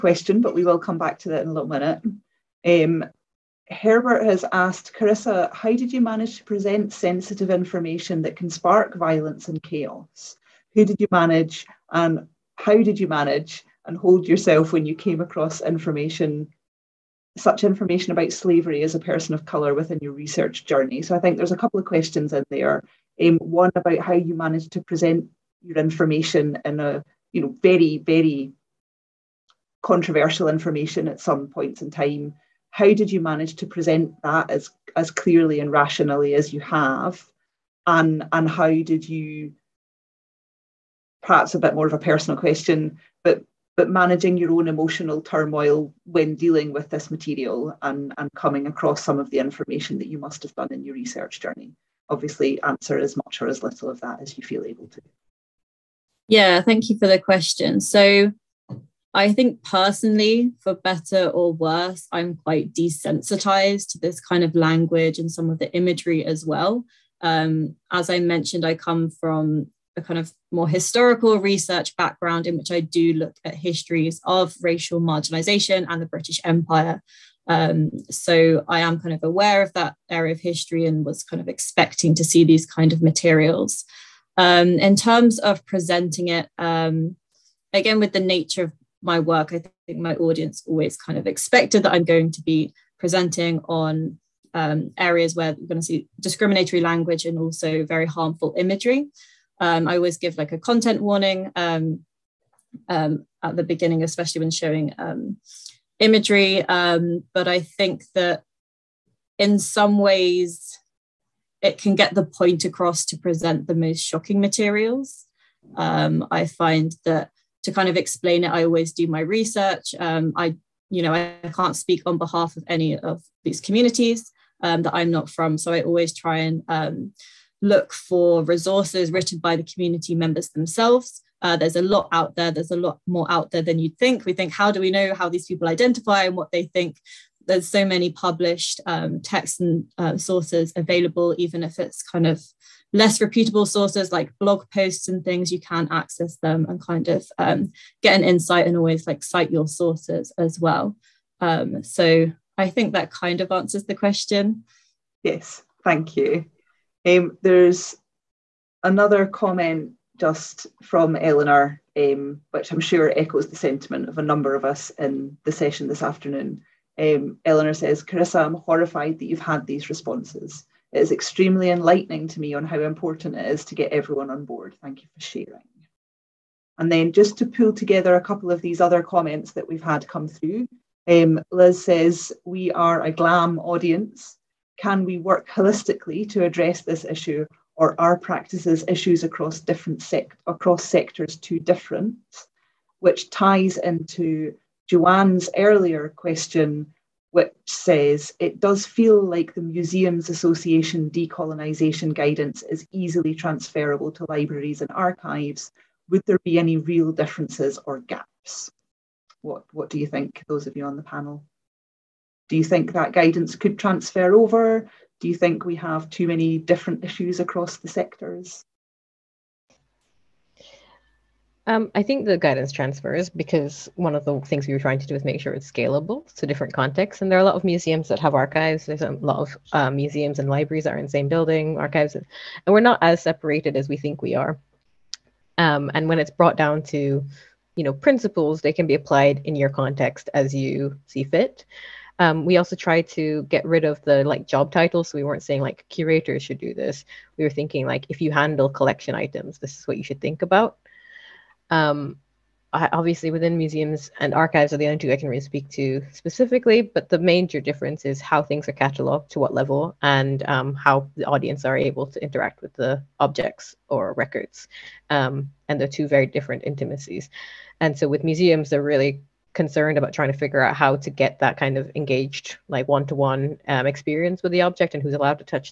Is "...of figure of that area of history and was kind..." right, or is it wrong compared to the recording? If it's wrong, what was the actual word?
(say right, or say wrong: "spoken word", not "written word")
wrong: "aware", not "figure".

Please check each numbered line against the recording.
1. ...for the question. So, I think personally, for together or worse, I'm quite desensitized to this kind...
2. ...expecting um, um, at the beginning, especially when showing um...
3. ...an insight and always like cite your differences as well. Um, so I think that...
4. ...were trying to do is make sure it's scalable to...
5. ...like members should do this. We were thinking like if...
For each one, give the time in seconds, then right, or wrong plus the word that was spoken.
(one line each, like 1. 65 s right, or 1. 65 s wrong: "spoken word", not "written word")
1. 56 s wrong: "better", not "together"
2. 101 s wrong: "warning", not "expecting"
3. 148 s wrong: "sources", not "differences"
4. 224 s right
5. 245 s wrong: "curators", not "members".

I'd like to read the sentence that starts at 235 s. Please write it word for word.
Um, and when it's brought down to, you know, principles, they can be applied in your context as you see fit.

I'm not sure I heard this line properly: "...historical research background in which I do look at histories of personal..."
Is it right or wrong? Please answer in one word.
wrong.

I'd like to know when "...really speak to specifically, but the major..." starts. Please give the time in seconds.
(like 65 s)
255 s.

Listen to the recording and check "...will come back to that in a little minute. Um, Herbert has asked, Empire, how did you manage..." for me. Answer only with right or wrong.
wrong.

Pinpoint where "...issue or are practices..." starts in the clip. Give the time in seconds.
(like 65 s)
187 s.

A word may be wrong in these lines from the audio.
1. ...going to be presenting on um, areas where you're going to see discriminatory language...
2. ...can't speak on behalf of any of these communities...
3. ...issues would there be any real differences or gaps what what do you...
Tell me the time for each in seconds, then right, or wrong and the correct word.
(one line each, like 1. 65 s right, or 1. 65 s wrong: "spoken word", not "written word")
1. 92 s right
2. 121 s right
3. 204 s wrong: "archives", not "issues".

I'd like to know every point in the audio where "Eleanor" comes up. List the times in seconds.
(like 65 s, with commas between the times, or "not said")
161 s, 167 s.